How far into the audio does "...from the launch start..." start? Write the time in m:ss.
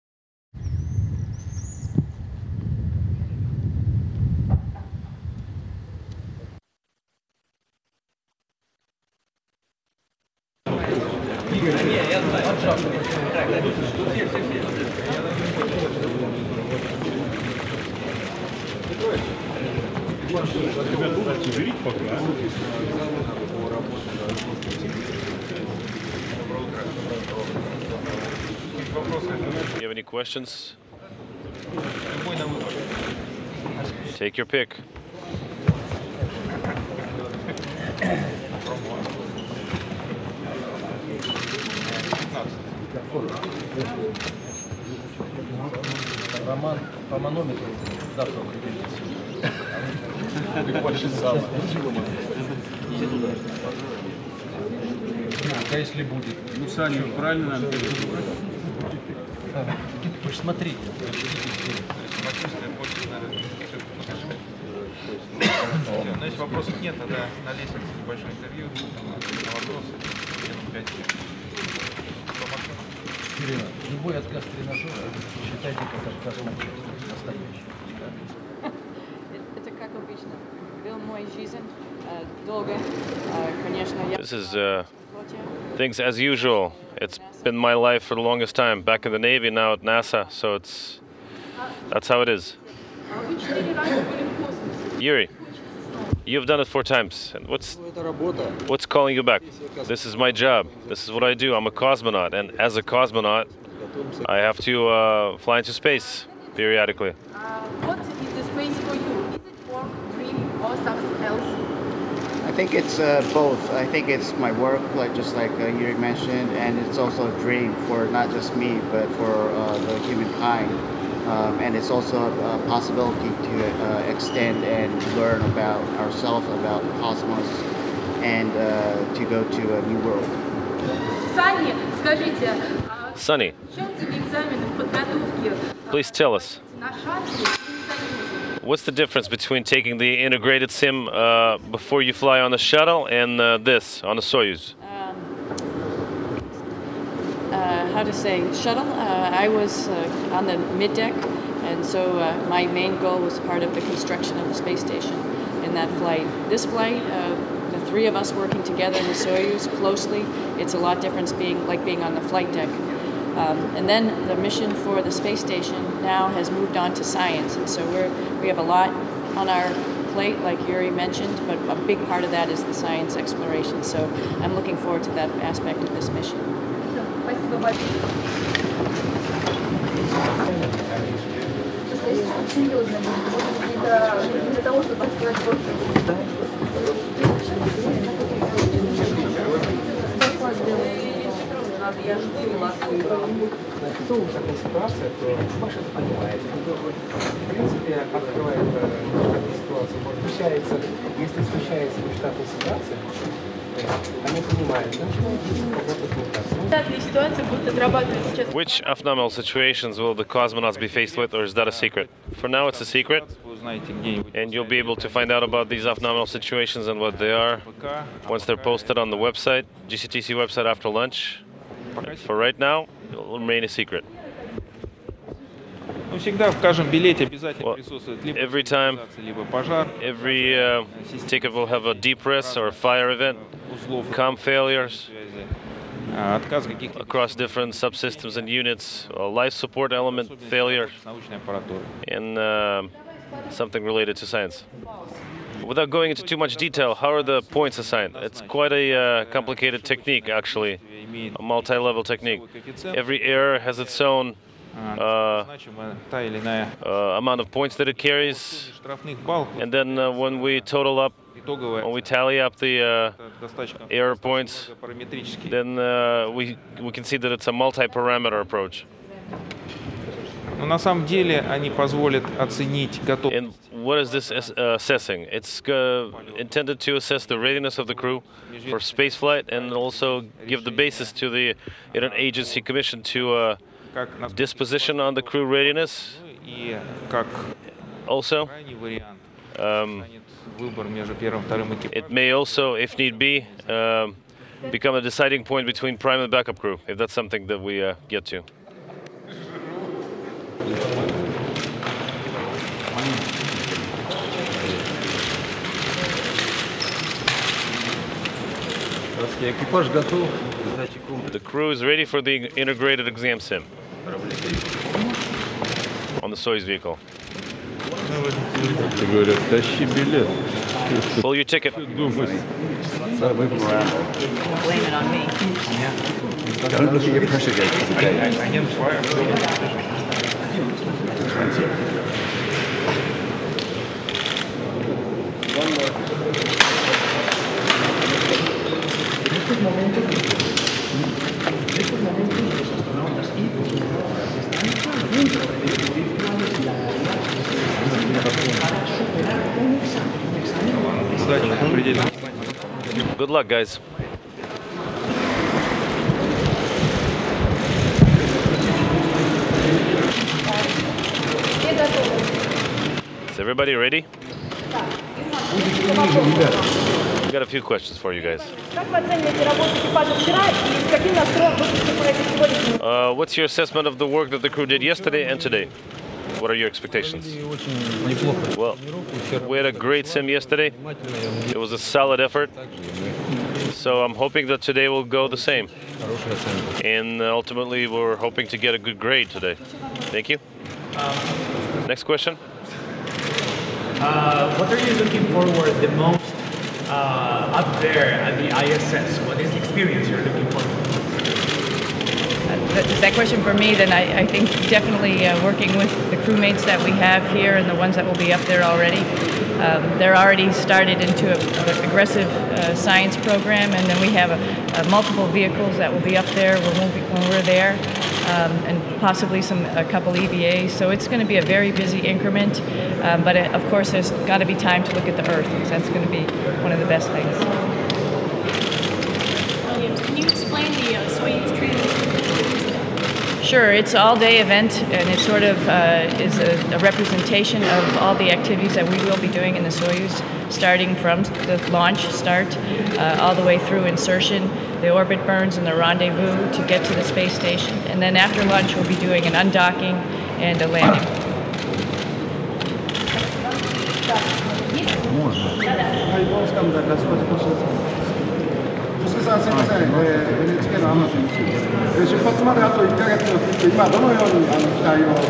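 7:20.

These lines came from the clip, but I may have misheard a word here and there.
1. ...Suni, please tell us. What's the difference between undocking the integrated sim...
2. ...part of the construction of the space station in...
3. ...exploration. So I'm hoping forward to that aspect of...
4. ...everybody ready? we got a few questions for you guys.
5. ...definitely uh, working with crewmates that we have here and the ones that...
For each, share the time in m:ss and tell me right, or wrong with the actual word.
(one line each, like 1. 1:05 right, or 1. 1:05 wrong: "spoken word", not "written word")
1. 2:13 wrong: "taking", not "undocking"
2. 2:33 right
3. 2:53 wrong: "looking", not "hoping"
4. 6:03 right
5. 6:44 right.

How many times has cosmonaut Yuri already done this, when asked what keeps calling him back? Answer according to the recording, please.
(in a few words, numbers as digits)
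4.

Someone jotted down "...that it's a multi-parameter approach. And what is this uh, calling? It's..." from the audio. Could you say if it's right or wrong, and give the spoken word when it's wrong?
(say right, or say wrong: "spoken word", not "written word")
wrong: "assessing", not "calling".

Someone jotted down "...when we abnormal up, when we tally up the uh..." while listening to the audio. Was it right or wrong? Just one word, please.
wrong.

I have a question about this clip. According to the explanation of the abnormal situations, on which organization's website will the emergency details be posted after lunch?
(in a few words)
GCTC.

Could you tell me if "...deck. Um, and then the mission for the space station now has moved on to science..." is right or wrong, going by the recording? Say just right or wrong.
right.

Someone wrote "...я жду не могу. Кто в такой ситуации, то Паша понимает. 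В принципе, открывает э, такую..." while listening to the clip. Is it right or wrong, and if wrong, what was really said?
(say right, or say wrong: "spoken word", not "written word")
right.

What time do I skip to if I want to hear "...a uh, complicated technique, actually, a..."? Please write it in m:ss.
4:08.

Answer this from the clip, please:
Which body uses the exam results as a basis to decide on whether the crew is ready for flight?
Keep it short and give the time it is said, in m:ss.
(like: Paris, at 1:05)
agency commission, at 4:42.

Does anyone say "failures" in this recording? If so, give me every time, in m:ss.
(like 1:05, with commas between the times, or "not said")
3:54, 4:00.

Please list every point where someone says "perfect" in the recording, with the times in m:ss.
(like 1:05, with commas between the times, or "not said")
not said.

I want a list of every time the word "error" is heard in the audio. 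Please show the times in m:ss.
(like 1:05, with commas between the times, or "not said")
4:13, 4:23.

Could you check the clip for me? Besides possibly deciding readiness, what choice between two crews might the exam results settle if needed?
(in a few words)
prime and backup crew.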